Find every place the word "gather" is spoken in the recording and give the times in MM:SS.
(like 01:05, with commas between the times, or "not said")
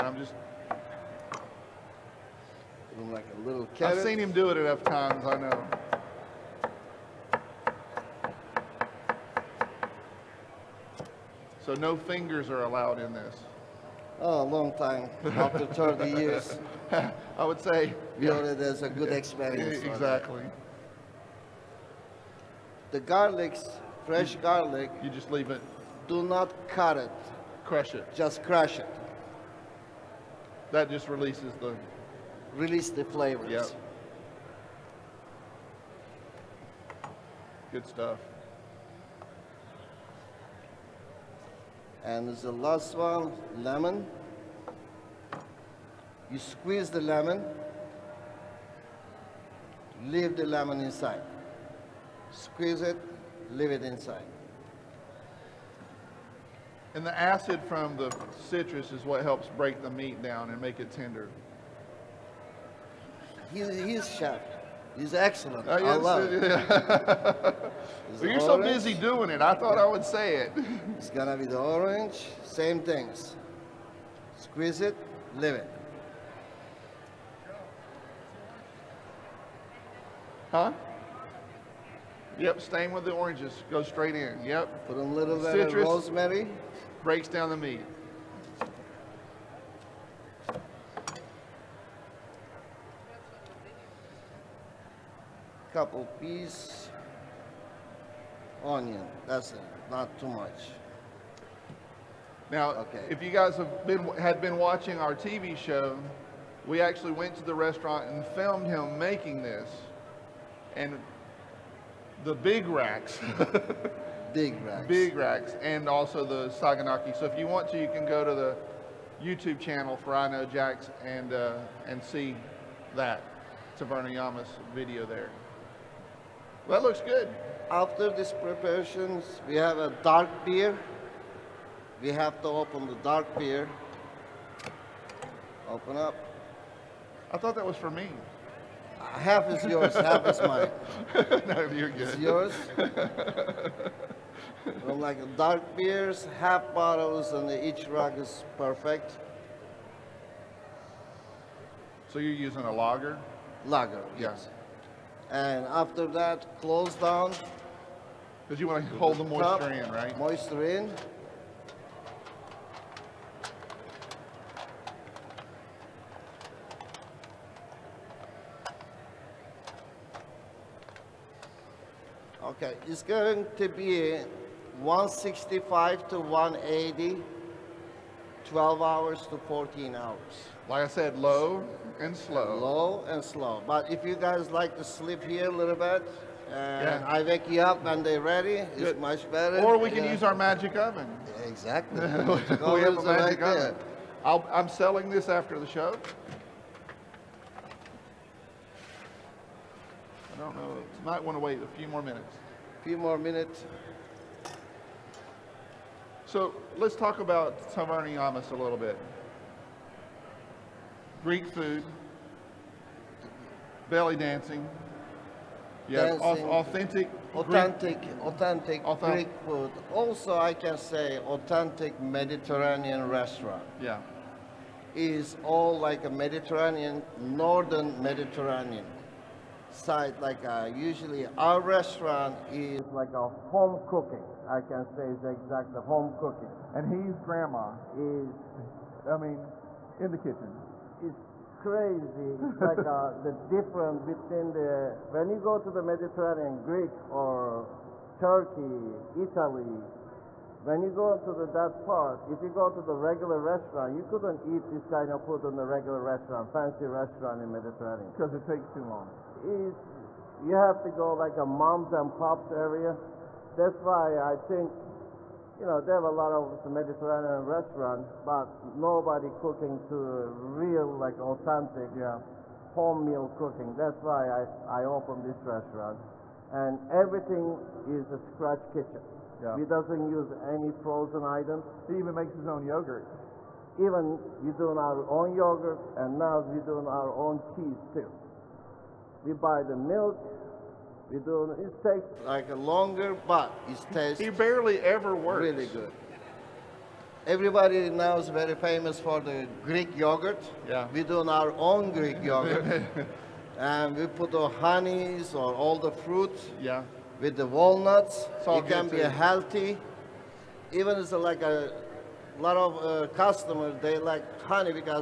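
not said.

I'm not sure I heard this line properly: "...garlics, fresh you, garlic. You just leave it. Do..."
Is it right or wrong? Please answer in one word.
right.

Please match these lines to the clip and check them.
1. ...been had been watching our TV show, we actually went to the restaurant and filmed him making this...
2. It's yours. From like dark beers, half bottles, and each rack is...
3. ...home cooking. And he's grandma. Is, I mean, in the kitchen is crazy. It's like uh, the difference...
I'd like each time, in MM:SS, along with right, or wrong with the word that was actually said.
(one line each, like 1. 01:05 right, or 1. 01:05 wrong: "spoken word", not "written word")
1. 01:43 right
2. 02:22 right
3. 03:55 right.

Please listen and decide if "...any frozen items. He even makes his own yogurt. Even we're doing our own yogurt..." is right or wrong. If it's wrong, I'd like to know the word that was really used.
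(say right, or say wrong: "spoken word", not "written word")
right.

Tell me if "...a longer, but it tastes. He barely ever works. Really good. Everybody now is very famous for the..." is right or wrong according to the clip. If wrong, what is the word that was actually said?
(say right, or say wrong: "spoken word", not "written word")
right.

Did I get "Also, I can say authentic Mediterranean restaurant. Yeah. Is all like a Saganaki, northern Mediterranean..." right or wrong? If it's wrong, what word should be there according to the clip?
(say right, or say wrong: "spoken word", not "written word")
wrong: "Mediterranean", not "Saganaki".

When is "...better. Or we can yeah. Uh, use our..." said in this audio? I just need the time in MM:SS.
03:09.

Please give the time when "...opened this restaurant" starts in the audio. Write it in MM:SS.
04:34.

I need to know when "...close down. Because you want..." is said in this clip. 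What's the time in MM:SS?
02:36.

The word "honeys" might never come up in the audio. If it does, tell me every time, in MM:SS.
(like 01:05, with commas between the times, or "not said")
05:04, 05:14.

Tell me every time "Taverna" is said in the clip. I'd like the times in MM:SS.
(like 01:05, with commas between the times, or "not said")
02:03, 03:27.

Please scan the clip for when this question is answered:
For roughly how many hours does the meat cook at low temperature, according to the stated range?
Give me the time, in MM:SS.
02:58.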